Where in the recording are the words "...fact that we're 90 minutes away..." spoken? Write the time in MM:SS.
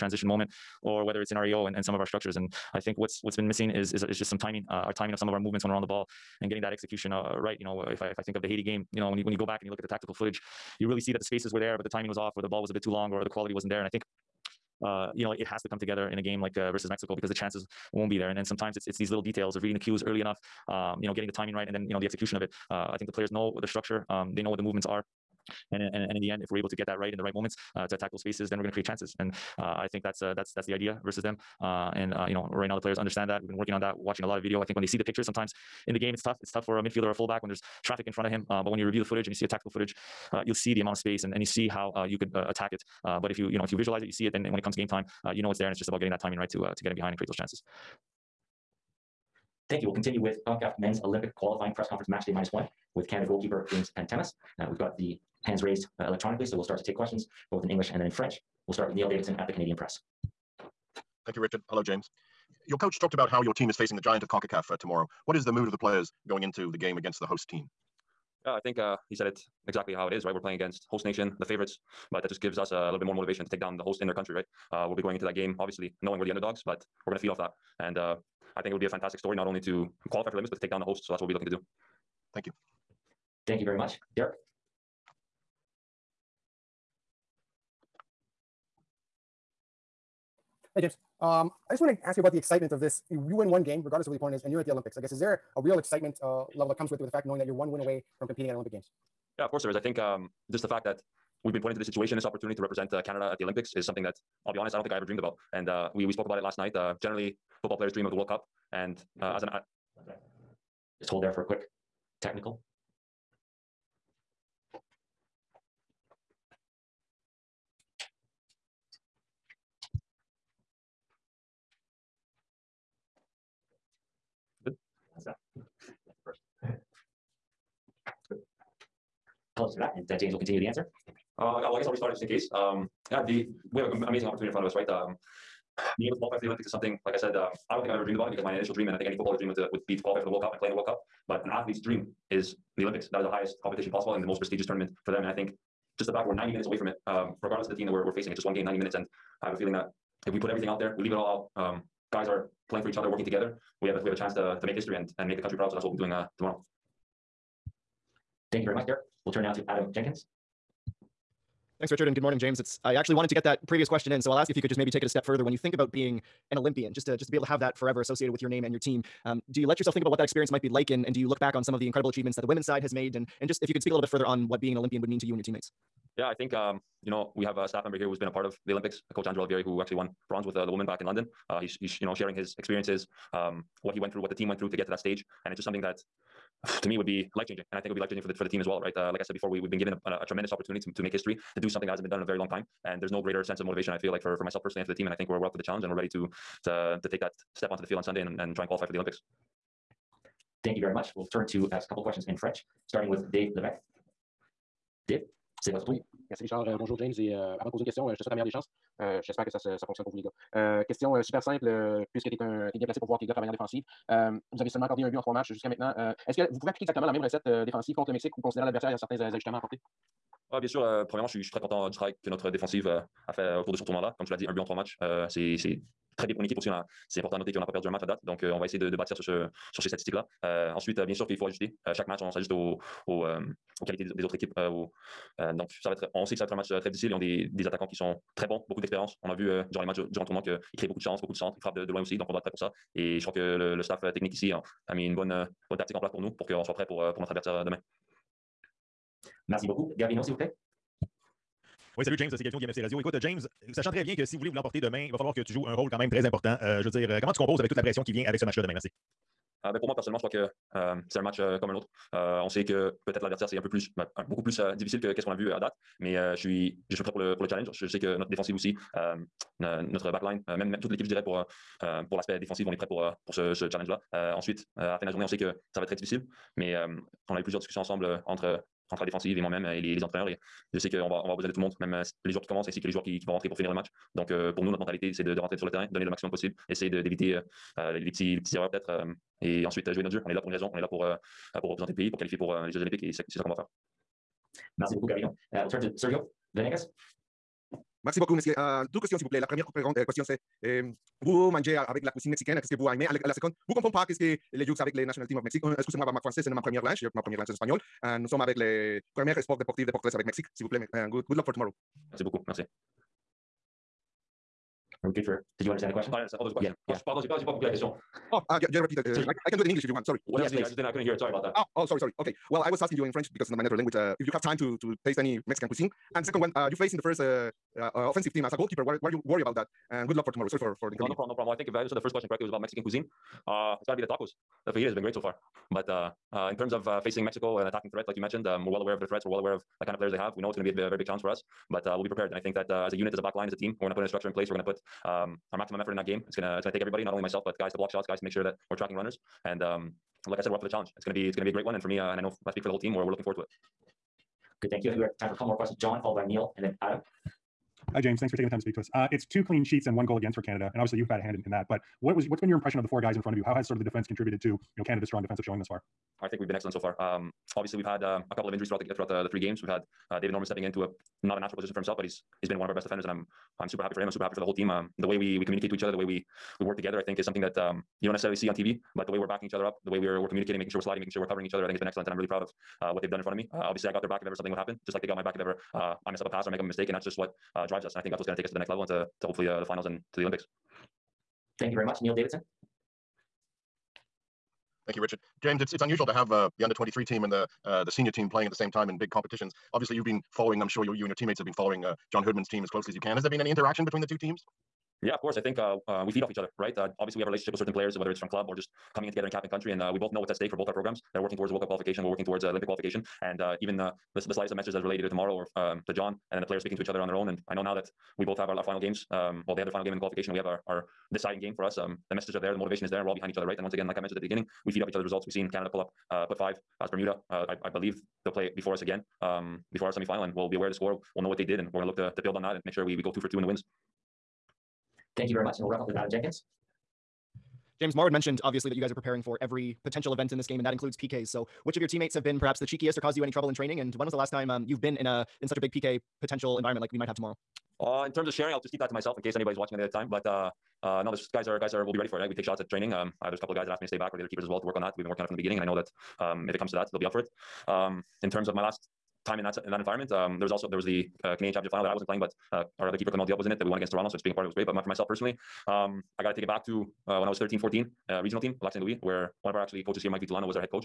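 02:26.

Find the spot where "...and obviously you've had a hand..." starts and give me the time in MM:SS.
06:00.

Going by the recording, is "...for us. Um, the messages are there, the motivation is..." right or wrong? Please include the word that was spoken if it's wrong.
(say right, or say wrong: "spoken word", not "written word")
right.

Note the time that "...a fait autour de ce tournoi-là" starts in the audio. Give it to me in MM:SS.
03:43.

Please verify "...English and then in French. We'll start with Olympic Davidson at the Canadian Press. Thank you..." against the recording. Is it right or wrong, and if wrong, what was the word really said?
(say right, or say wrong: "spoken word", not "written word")
wrong: "Neil", not "Olympic".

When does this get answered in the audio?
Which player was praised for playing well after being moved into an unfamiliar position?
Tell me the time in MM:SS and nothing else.
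06:10.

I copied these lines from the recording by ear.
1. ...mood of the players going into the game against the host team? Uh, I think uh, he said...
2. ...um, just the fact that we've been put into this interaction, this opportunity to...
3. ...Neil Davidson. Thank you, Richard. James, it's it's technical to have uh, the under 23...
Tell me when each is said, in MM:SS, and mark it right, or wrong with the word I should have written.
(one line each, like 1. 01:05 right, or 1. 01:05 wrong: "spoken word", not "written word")
1. 01:05 right
2. 01:39 wrong: "situation", not "interaction"
3. 06:32 wrong: "unusual", not "technical".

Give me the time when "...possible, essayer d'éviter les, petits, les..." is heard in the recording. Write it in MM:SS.
04:46.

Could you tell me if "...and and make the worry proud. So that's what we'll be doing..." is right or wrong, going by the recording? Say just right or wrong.
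wrong.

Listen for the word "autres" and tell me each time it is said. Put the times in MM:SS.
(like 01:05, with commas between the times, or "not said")
03:54, 04:21.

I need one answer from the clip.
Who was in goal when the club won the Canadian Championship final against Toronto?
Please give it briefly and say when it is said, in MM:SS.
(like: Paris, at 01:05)
Clement Diop, at 07:43.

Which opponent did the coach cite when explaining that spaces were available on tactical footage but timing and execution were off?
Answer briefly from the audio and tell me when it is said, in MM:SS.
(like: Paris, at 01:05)
Haiti, at 00:08.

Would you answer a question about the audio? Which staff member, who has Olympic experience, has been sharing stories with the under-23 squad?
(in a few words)
Andrew Olivieri.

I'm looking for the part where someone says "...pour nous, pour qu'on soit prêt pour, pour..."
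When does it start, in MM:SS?
04:06.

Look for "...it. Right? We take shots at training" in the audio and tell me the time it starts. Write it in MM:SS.
07:32.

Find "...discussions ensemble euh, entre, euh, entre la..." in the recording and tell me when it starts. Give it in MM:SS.
04:37.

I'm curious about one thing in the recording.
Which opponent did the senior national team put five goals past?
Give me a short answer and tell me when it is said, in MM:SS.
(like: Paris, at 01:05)
Bermuda, at 07:06.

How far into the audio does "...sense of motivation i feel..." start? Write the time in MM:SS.
03:13.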